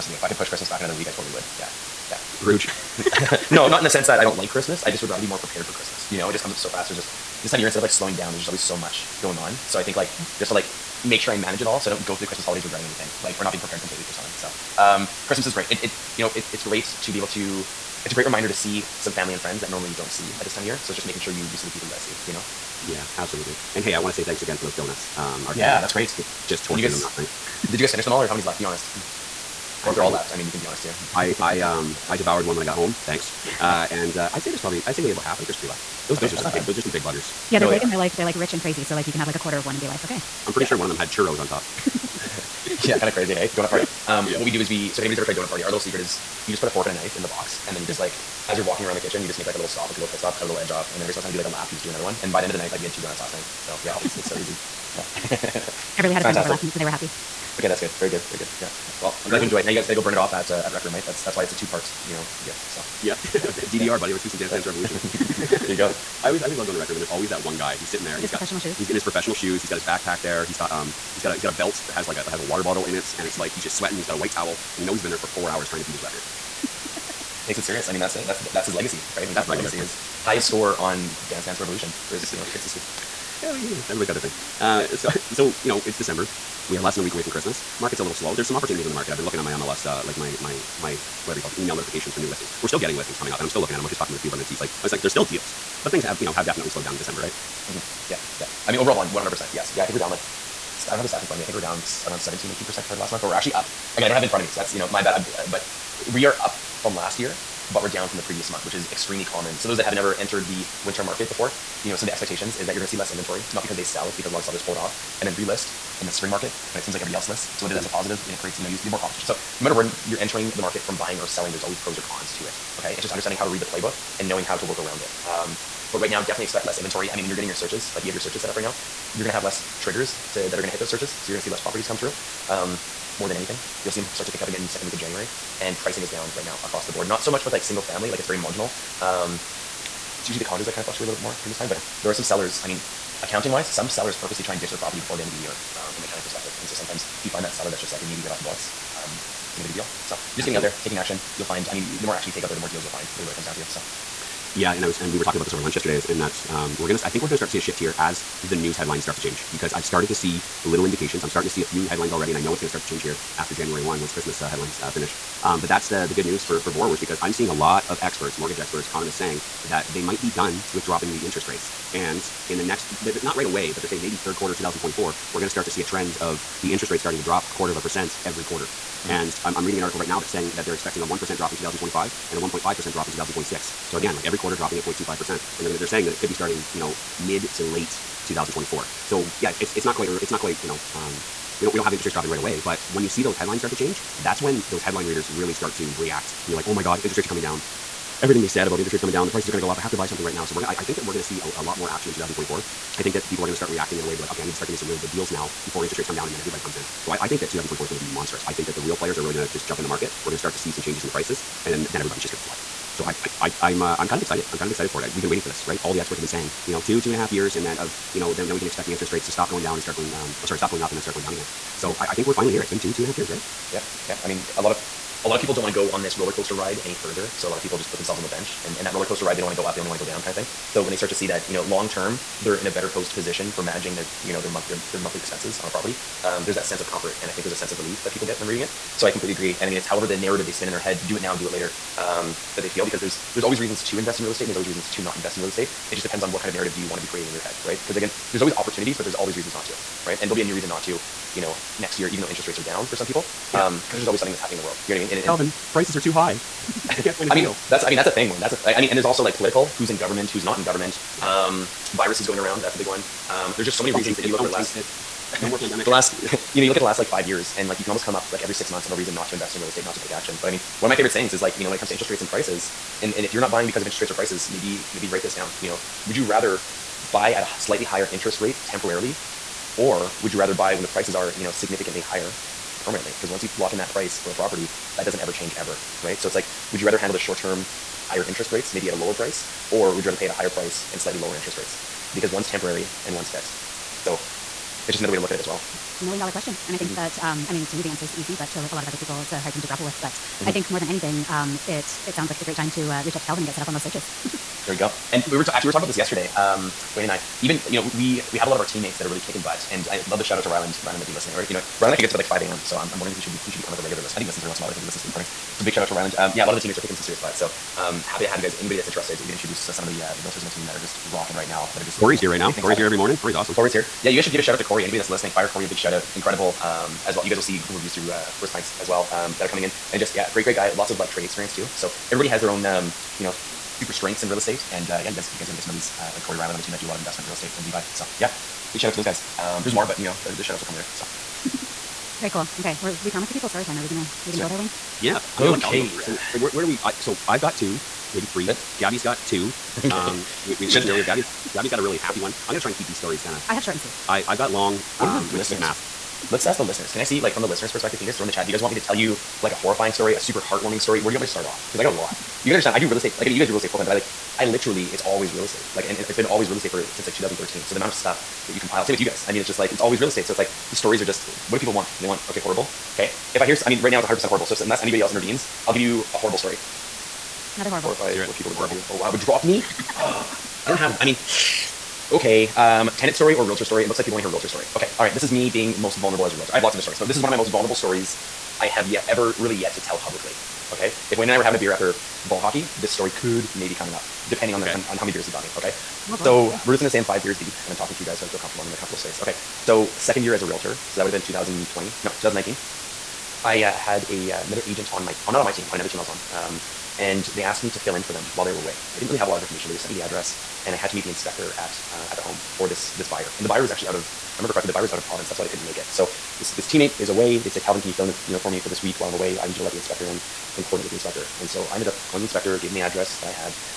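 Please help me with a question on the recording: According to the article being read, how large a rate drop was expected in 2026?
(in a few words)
1.5%.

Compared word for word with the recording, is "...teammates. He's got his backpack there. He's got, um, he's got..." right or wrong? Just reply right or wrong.
wrong.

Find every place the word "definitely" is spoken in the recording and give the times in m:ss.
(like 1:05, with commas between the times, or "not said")
1:36, 2:06.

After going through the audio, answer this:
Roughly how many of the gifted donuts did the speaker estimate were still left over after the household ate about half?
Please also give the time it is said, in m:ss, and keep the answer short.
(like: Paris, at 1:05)
3, at 0:35.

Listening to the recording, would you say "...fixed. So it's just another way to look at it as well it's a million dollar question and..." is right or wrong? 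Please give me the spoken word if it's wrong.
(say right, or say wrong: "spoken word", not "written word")
right.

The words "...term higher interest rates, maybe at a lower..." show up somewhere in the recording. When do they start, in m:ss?
4:47.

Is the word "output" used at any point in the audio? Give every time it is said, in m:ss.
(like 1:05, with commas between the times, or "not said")
not said.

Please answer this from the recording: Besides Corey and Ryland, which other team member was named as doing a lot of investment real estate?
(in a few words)
Levi.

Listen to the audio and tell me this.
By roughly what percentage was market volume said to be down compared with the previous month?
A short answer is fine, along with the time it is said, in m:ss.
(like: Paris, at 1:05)
17, 18 percent, at 1:42.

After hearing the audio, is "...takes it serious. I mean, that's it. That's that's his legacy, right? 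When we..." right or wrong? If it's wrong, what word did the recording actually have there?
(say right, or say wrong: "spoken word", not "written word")
right.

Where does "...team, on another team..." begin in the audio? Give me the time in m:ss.
6:45.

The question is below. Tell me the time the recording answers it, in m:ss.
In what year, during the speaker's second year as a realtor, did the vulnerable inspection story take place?
6:42.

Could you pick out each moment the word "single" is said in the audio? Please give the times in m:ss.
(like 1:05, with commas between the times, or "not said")
0:51, 2:17.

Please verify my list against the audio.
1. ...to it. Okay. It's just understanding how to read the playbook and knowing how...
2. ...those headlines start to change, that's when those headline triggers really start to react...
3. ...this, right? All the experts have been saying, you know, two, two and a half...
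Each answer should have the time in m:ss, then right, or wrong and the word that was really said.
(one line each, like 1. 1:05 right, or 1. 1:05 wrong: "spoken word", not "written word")
1. 2:02 right
2. 3:13 wrong: "readers", not "triggers"
3. 3:35 right.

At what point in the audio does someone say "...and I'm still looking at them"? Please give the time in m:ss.
1:33.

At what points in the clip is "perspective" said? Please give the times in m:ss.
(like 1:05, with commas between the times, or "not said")
2:26, 5:57.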